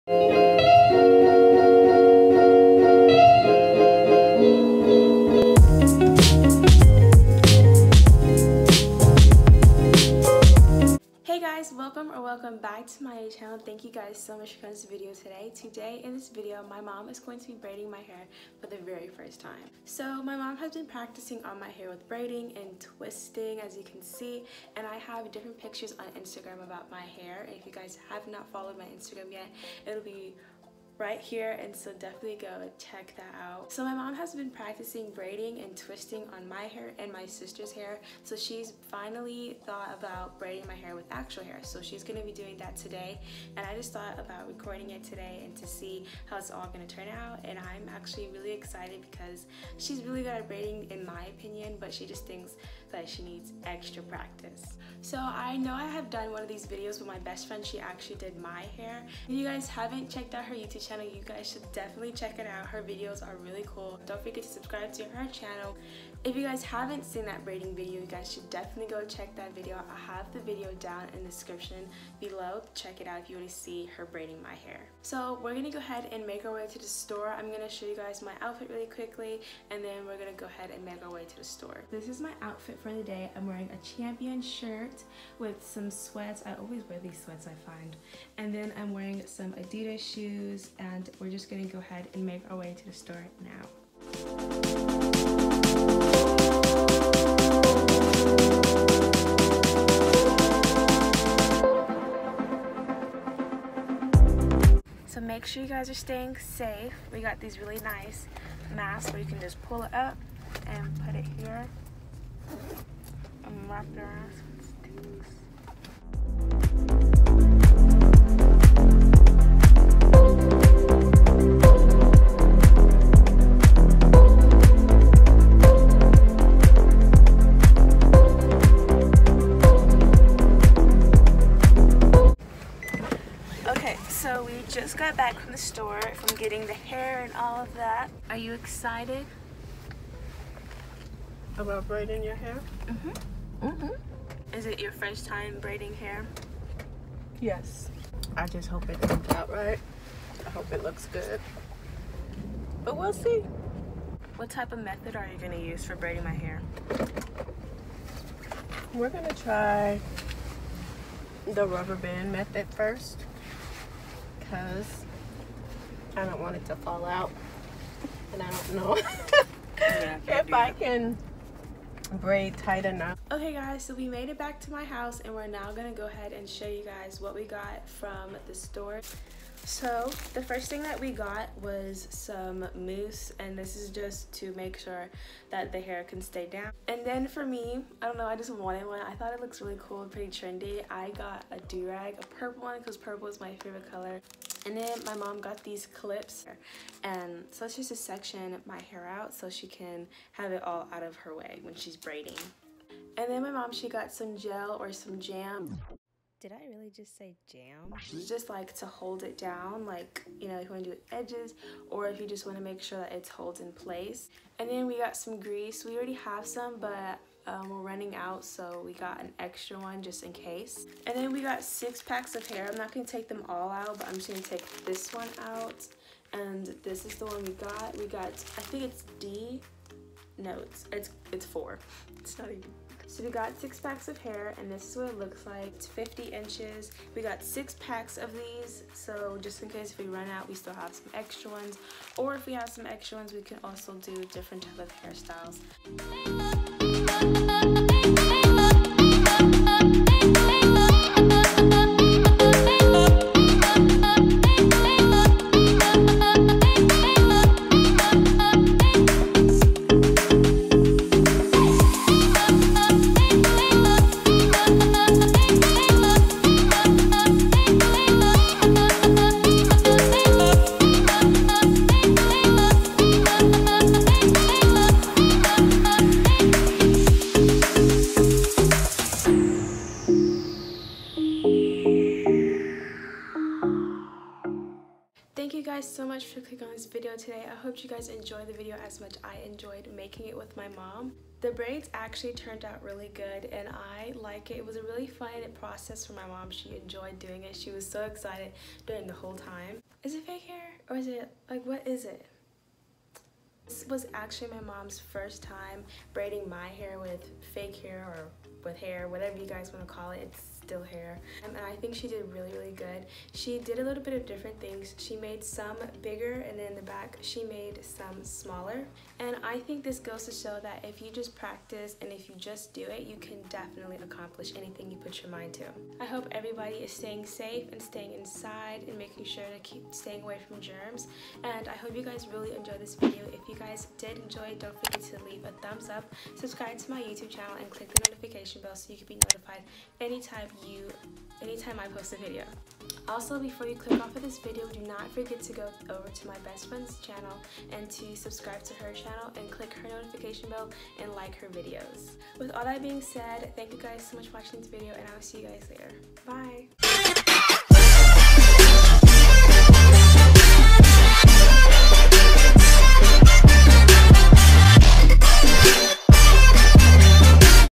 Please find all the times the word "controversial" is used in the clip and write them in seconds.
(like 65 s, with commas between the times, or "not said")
not said.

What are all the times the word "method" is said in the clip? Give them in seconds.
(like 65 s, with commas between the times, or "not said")
154 s, 162 s.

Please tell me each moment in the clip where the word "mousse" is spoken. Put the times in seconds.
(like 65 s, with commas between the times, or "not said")
182 s.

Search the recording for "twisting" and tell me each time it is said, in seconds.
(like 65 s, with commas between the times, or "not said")
22 s, 35 s.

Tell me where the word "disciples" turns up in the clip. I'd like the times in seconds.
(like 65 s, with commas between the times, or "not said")
not said.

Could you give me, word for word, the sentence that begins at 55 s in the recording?
So I know I have done one of these videos with my best friend.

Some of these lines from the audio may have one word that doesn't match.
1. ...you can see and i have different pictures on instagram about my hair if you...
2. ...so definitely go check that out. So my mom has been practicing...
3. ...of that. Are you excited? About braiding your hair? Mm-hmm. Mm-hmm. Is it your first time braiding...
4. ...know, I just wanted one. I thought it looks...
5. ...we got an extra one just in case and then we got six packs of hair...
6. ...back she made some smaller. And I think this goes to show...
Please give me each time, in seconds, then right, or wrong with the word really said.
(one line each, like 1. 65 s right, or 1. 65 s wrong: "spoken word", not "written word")
1. 23 s right
2. 31 s right
3. 137 s right
4. 188 s right
5. 218 s right
6. 316 s right.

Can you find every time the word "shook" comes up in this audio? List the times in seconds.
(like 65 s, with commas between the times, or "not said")
not said.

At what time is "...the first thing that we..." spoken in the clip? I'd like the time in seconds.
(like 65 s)
180 s.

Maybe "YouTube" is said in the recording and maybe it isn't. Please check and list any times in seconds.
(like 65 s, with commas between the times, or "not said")
60 s, 337 s.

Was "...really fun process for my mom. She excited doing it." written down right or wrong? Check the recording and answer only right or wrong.
wrong.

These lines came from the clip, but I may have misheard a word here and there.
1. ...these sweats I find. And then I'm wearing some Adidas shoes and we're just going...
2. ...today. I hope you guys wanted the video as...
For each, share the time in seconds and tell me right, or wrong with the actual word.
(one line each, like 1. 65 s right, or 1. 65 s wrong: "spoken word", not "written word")
1. 86 s right
2. 287 s wrong: "enjoyed", not "wanted".